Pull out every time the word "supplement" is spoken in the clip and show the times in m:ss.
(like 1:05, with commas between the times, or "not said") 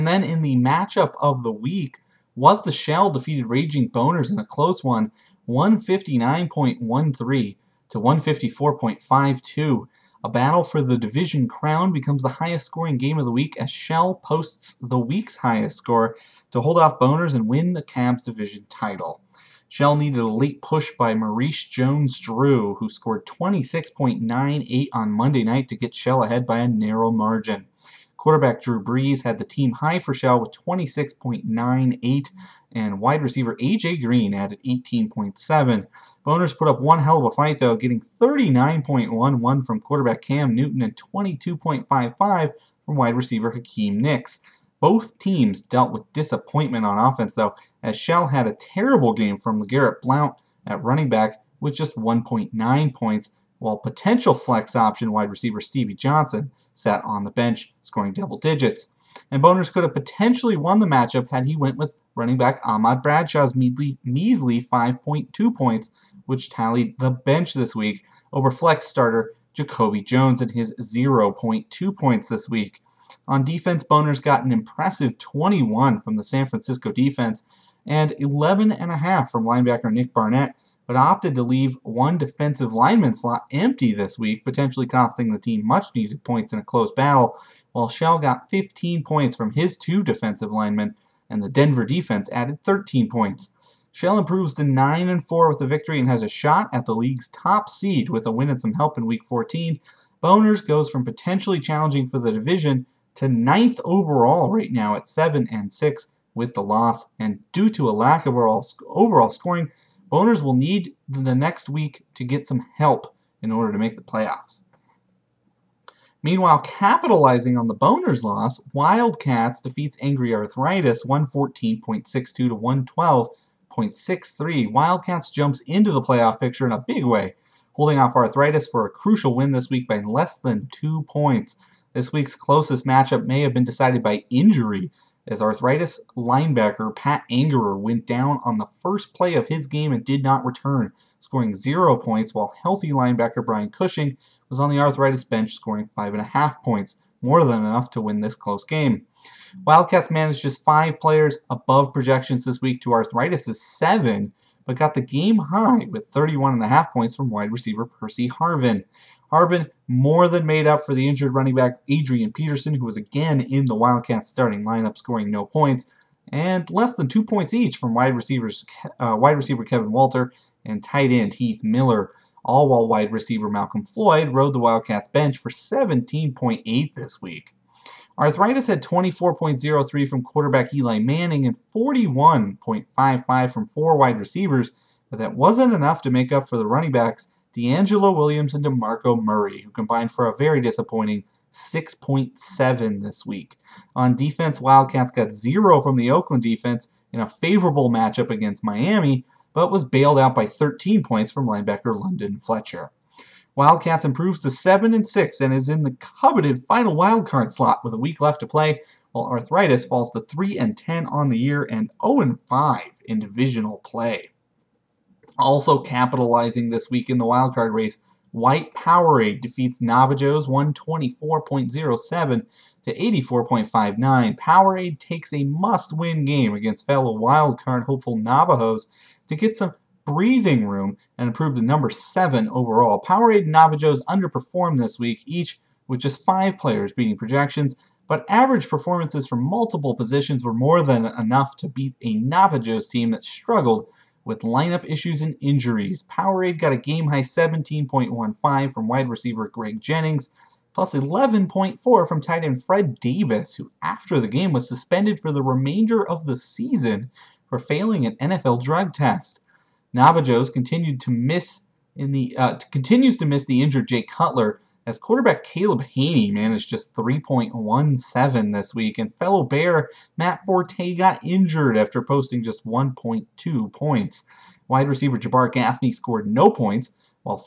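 not said.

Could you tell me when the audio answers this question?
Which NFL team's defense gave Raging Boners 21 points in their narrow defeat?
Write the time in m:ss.
1:16.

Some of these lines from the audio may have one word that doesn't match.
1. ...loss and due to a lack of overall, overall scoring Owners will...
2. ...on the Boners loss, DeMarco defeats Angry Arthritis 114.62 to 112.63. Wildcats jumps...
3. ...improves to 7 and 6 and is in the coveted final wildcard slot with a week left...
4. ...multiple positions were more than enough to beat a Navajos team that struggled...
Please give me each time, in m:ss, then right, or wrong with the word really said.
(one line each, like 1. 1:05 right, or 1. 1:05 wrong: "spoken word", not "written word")
1. 1:46 right
2. 1:57 wrong: "Wildcats", not "DeMarco"
3. 3:24 right
4. 3:59 right.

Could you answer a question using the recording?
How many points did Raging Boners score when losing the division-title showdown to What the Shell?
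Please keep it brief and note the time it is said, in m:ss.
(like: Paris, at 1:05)
154.52, at 0:07.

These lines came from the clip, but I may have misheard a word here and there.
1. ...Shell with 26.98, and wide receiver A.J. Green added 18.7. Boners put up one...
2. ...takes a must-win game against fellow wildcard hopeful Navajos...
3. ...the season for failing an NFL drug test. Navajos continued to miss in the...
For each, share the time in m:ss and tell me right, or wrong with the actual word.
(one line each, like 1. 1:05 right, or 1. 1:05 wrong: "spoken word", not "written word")
1. 0:30 right
2. 3:44 right
3. 4:16 right.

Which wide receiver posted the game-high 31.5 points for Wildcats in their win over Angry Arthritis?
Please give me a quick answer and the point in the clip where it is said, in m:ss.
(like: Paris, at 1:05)
Percy Harvin, at 2:37.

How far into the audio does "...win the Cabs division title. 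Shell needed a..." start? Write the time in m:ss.
0:17.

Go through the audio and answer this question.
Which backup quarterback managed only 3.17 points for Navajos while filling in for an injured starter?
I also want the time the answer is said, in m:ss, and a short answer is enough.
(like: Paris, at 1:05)
Caleb Hanie, at 4:25.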